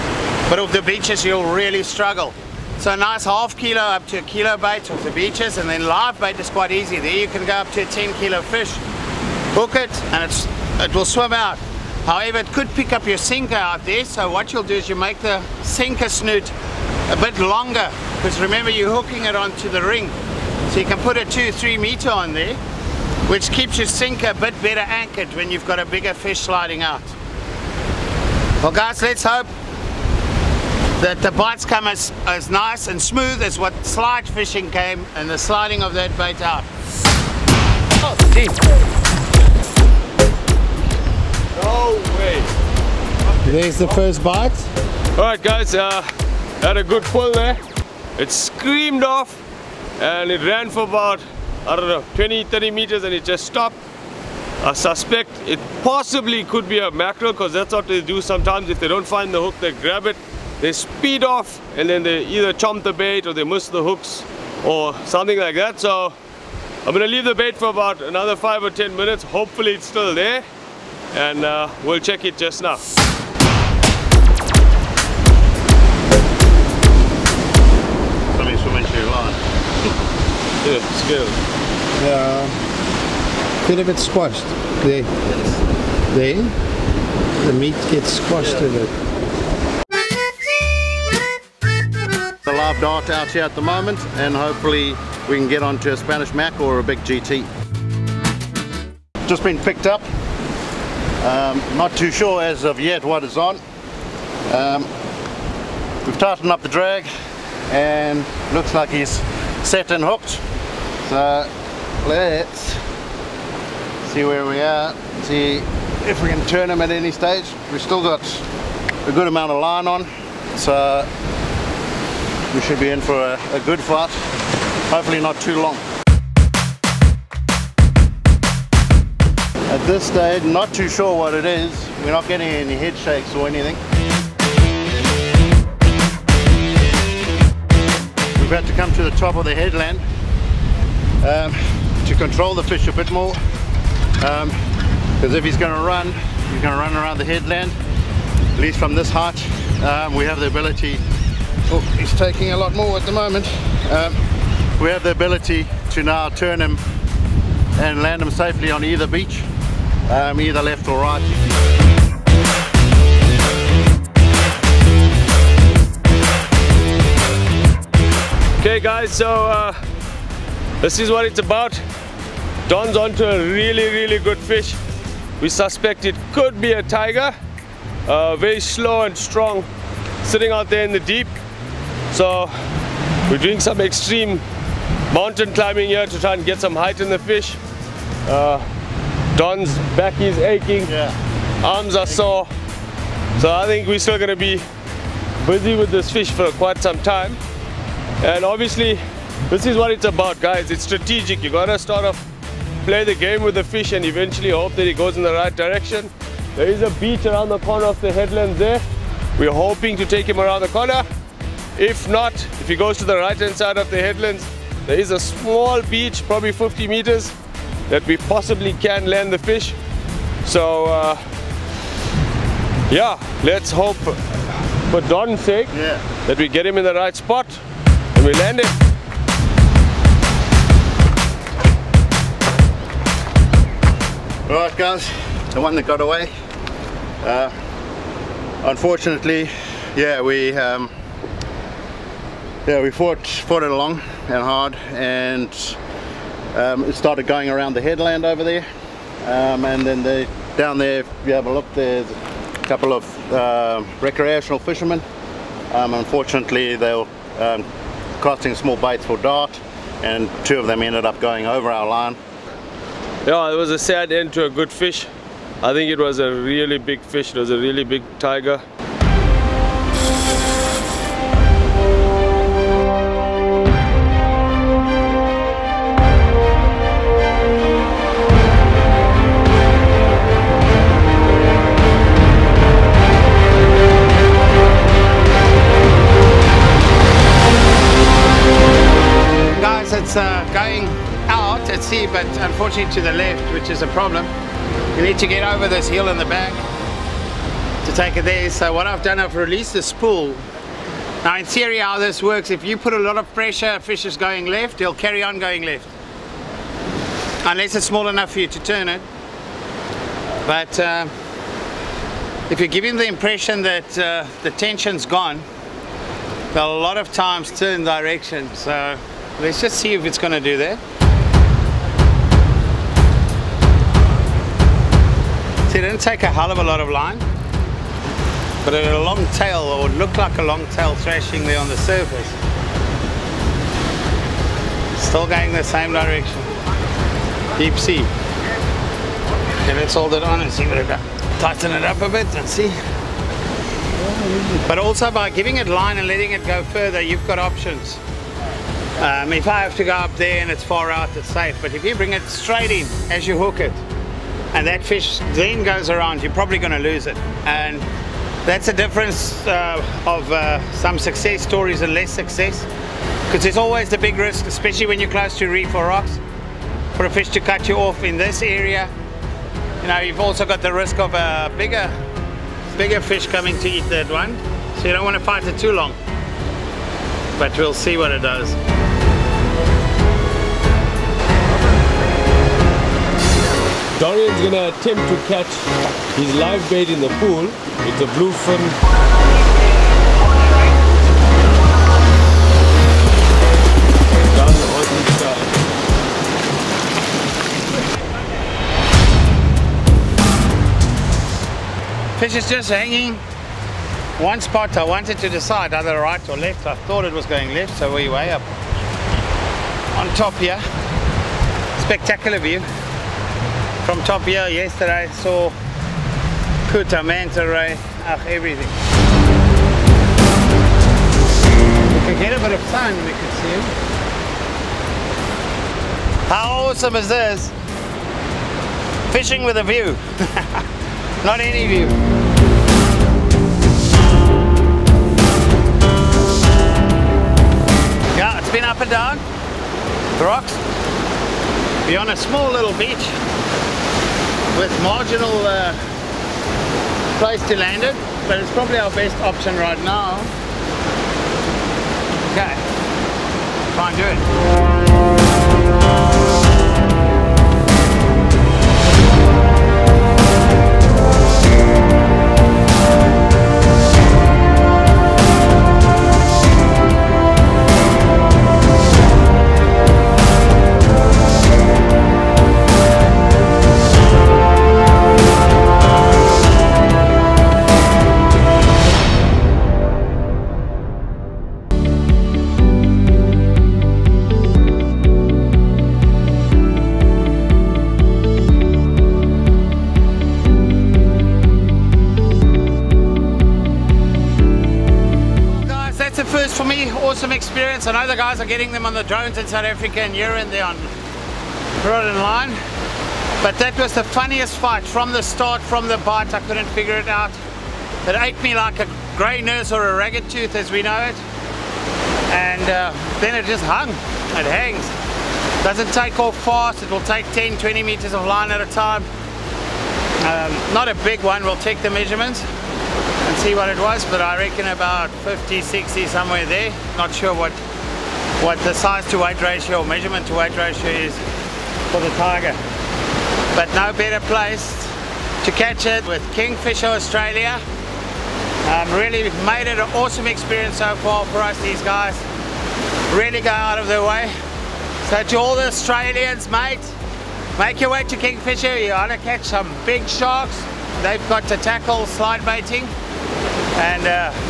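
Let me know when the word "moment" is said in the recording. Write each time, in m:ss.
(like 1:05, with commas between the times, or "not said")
1:33, 2:33.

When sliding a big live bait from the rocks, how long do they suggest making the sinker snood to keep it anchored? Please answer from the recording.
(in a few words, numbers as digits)
2 to 3 meters.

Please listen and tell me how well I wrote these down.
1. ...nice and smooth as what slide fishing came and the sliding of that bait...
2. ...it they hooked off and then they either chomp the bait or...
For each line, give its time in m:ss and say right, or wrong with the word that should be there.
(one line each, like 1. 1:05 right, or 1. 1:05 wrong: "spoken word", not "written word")
1. 0:32 right
2. 1:00 wrong: "speed", not "hooked".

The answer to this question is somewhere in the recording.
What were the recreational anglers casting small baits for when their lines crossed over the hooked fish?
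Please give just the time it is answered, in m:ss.
4:19.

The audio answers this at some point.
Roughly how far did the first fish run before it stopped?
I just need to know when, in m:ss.
0:52.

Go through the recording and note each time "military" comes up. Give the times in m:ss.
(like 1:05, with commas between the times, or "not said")
not said.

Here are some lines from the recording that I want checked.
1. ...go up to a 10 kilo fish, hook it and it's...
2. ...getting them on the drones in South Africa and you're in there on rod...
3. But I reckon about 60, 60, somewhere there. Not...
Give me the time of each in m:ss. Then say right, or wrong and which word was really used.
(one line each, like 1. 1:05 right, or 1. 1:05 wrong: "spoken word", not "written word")
1. 0:07 right
2. 8:18 right
3. 8:44 wrong: "50", not "60".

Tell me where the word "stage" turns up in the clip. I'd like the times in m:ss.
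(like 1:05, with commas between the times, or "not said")
1:57, 2:10.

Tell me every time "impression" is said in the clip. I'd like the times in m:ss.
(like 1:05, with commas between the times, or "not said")
5:13.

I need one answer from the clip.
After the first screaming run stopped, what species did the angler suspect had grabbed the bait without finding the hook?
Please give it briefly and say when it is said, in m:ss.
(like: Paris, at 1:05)
mackerel, at 0:56.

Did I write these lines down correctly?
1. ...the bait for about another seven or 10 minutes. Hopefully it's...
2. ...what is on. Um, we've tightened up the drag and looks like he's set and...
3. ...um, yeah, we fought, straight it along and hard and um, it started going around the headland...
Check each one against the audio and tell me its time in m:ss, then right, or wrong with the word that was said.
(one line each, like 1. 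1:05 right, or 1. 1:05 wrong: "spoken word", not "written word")
1. 1:07 wrong: "five", not "seven"
2. 1:43 right
3. 4:00 wrong: "fought", not "straight".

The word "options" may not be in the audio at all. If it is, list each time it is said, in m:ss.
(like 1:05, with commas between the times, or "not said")
5:47, 7:29.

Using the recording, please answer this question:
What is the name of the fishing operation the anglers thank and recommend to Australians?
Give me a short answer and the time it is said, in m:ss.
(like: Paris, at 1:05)
Kingfisher Australia, at 8:56.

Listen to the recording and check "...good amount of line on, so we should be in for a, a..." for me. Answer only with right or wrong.
right.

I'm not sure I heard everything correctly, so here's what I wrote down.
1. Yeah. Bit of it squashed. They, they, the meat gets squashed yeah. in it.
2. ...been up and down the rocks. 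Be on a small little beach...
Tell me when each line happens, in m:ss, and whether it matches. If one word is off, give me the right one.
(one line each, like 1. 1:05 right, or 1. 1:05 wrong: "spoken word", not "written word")
1. 1:22 right
2. 7:18 right.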